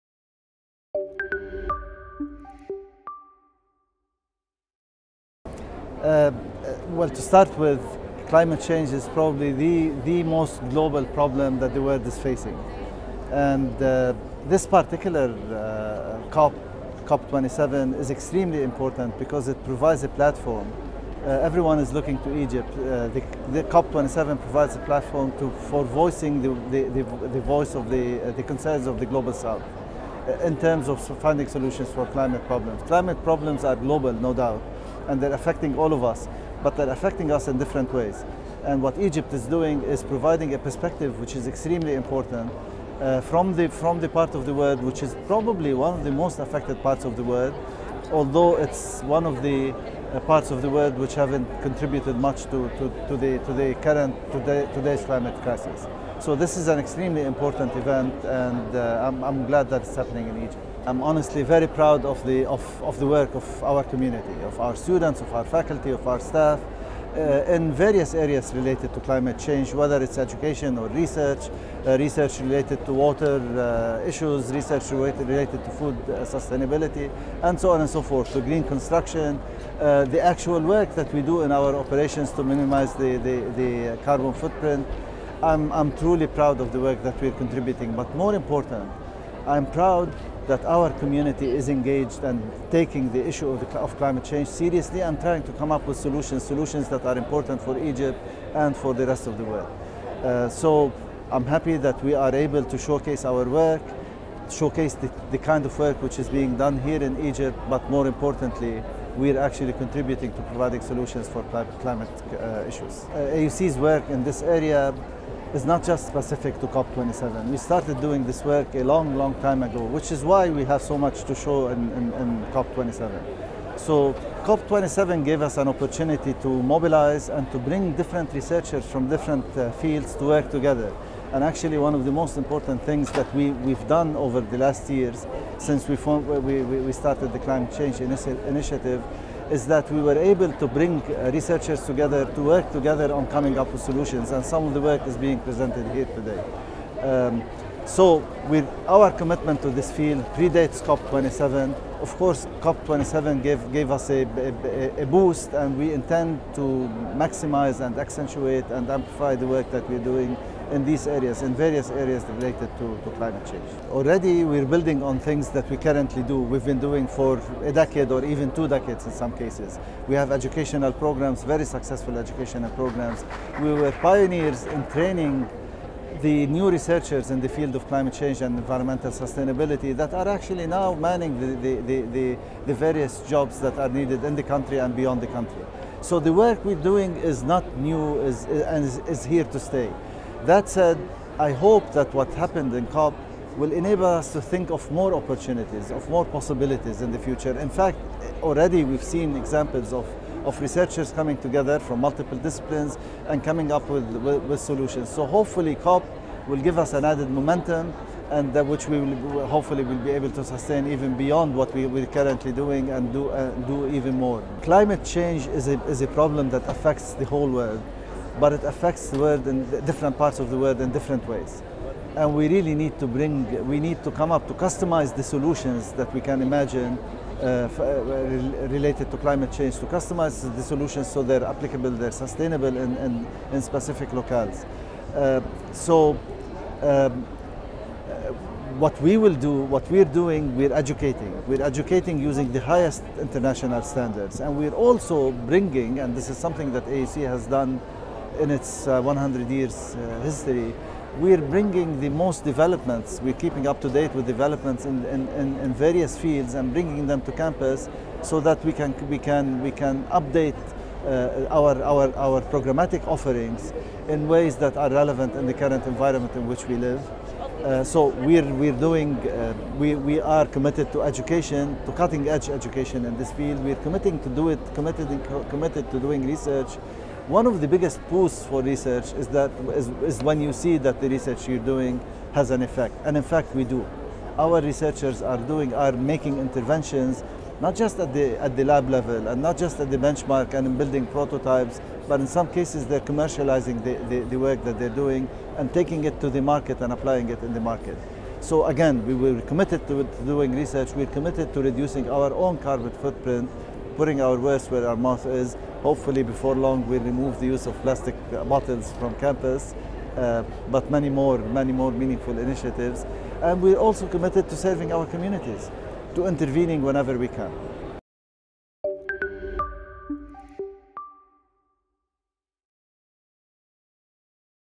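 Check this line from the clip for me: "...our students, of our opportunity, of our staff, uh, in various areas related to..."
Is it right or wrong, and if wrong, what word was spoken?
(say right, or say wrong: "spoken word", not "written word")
wrong: "faculty", not "opportunity".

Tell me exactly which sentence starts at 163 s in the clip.
Already we're building on things that we currently do.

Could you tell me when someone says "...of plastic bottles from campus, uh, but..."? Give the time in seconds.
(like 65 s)
307 s.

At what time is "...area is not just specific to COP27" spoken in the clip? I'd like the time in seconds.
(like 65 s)
114 s.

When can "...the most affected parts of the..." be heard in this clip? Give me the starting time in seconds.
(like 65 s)
46 s.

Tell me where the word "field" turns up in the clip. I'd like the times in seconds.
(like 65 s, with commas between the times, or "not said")
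129 s, 149 s, 177 s, 256 s, 273 s.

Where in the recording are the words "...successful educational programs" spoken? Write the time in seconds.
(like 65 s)
171 s.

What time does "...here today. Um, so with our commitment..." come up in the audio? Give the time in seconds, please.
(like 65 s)
145 s.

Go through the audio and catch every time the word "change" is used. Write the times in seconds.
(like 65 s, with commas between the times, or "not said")
8 s, 69 s, 94 s, 137 s, 163 s, 178 s, 215 s, 229 s.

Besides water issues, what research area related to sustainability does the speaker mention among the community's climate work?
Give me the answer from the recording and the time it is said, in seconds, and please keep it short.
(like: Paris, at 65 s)
food, at 75 s.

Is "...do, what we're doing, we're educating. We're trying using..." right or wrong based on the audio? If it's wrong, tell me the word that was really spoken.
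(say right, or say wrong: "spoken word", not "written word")
wrong: "educating", not "trying".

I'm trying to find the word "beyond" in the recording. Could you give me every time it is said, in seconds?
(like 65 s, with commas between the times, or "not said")
184 s, 211 s.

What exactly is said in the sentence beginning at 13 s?
And uh, this particular uh, COP, COP27 is extremely important because it provides a platform.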